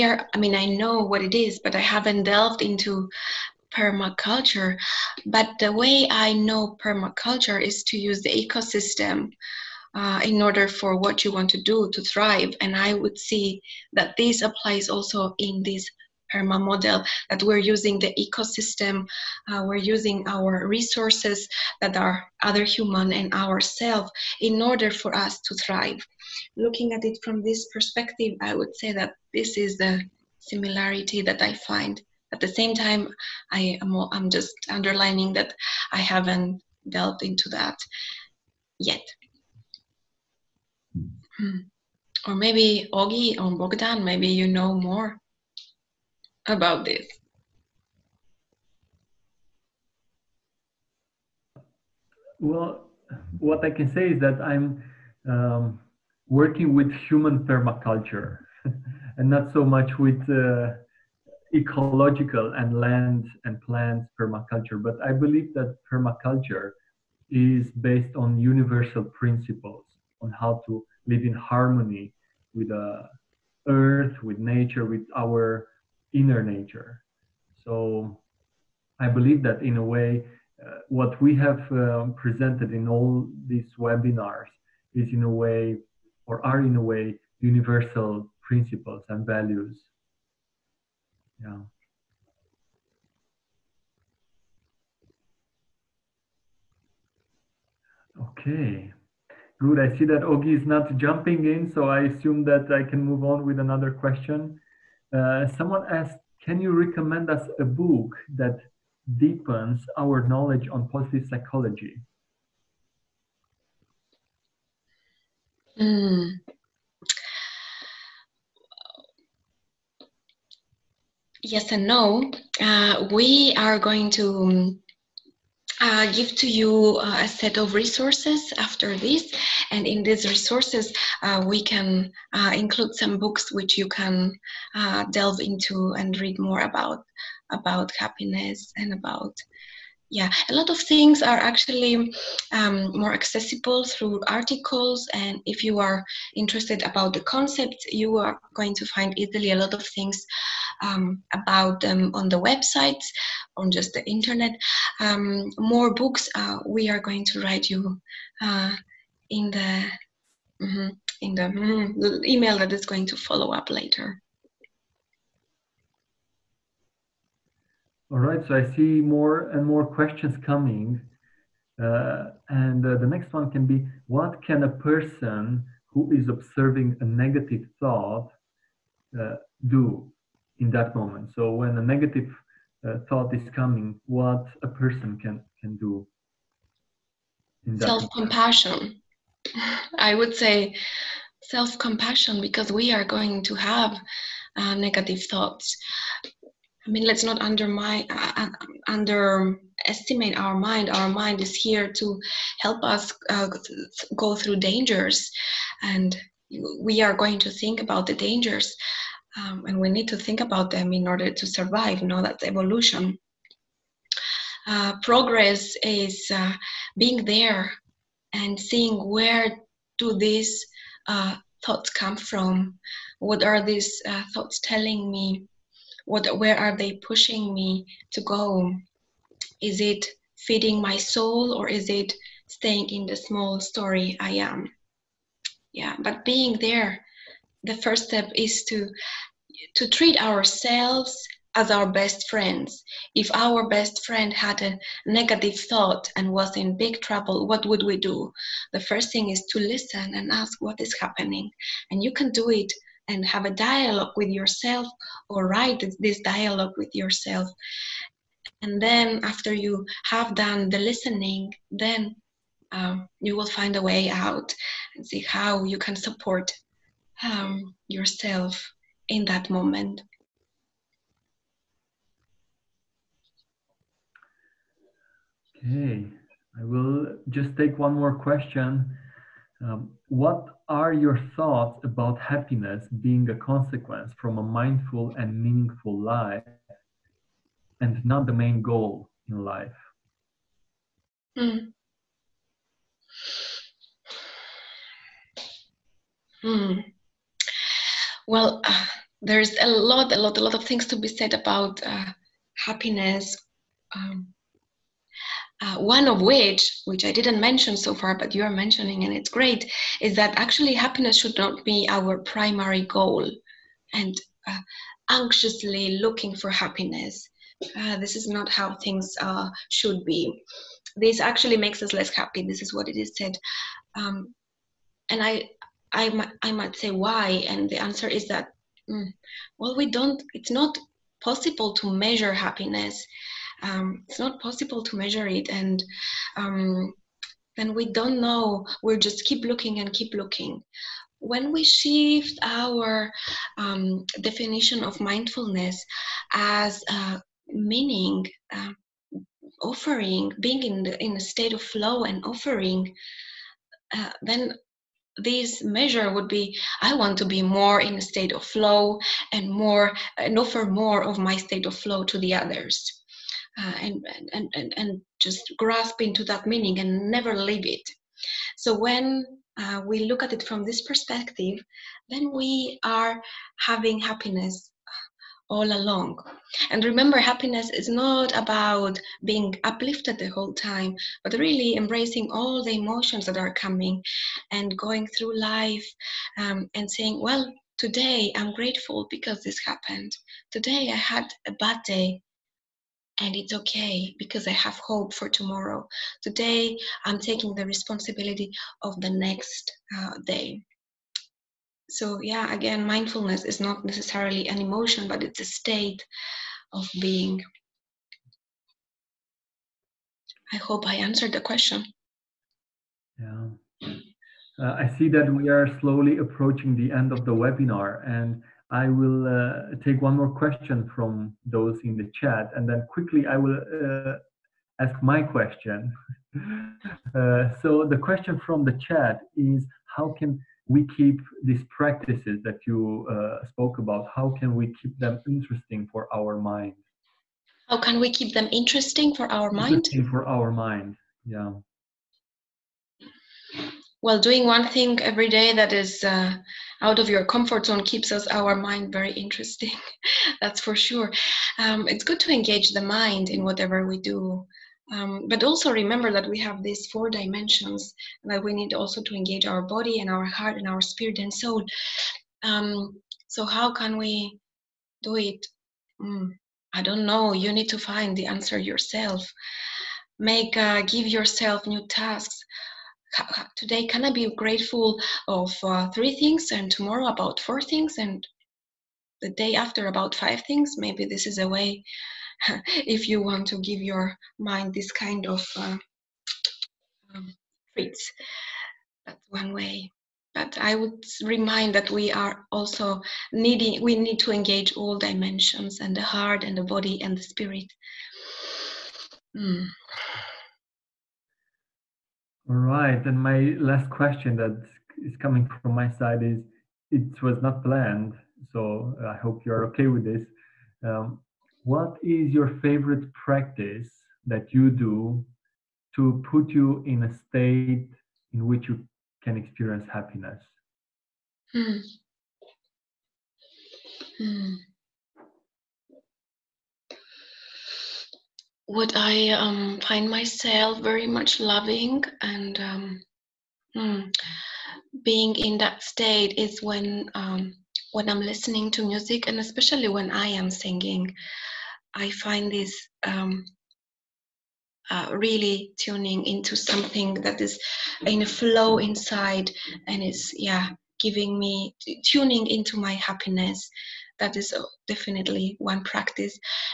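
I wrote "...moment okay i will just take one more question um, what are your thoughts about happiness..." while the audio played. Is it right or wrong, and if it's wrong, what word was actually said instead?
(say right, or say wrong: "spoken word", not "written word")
right.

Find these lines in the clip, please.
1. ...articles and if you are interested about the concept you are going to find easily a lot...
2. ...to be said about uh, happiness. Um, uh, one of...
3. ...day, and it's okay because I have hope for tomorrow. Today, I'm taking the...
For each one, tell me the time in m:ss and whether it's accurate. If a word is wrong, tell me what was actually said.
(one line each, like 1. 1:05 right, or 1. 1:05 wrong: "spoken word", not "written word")
1. 2:24 right
2. 5:00 right
3. 6:31 right.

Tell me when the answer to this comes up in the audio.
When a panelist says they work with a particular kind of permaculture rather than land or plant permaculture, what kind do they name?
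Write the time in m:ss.
0:57.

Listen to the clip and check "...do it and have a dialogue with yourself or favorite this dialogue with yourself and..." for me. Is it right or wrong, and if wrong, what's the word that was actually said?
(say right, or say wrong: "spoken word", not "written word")
wrong: "write", not "favorite".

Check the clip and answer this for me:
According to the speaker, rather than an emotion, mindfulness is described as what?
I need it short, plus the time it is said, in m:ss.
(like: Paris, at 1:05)
A state of being, at 6:45.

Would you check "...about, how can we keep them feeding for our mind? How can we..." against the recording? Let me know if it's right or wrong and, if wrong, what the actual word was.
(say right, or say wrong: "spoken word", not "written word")
wrong: "interesting", not "feeding".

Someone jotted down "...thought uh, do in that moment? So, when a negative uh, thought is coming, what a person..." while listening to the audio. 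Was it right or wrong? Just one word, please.
right.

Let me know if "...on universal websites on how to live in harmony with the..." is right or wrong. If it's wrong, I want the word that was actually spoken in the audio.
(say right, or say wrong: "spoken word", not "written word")
wrong: "principles", not "websites".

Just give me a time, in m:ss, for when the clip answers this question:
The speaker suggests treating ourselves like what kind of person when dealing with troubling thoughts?
4:01.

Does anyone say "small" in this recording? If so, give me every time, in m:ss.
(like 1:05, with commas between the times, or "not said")
3:53.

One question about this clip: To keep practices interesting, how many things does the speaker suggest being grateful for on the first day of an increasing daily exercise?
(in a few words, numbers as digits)
3.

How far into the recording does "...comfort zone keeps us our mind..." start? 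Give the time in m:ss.
7:27.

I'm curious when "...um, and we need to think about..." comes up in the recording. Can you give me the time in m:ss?
3:29.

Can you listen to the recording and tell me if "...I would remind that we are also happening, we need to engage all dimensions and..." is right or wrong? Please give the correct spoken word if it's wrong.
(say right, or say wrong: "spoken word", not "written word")
wrong: "needing", not "happening".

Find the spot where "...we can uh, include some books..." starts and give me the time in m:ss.
2:11.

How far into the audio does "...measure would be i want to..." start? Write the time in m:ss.
5:55.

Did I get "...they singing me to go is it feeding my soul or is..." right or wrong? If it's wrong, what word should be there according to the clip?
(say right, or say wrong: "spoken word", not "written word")
wrong: "pushing", not "singing".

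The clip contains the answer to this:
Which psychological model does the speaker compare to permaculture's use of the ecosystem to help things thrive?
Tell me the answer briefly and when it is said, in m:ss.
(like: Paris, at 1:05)
PERMA model, at 0:16.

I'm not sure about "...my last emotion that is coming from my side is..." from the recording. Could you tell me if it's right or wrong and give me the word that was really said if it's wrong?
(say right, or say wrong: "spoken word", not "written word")
wrong: "question", not "emotion".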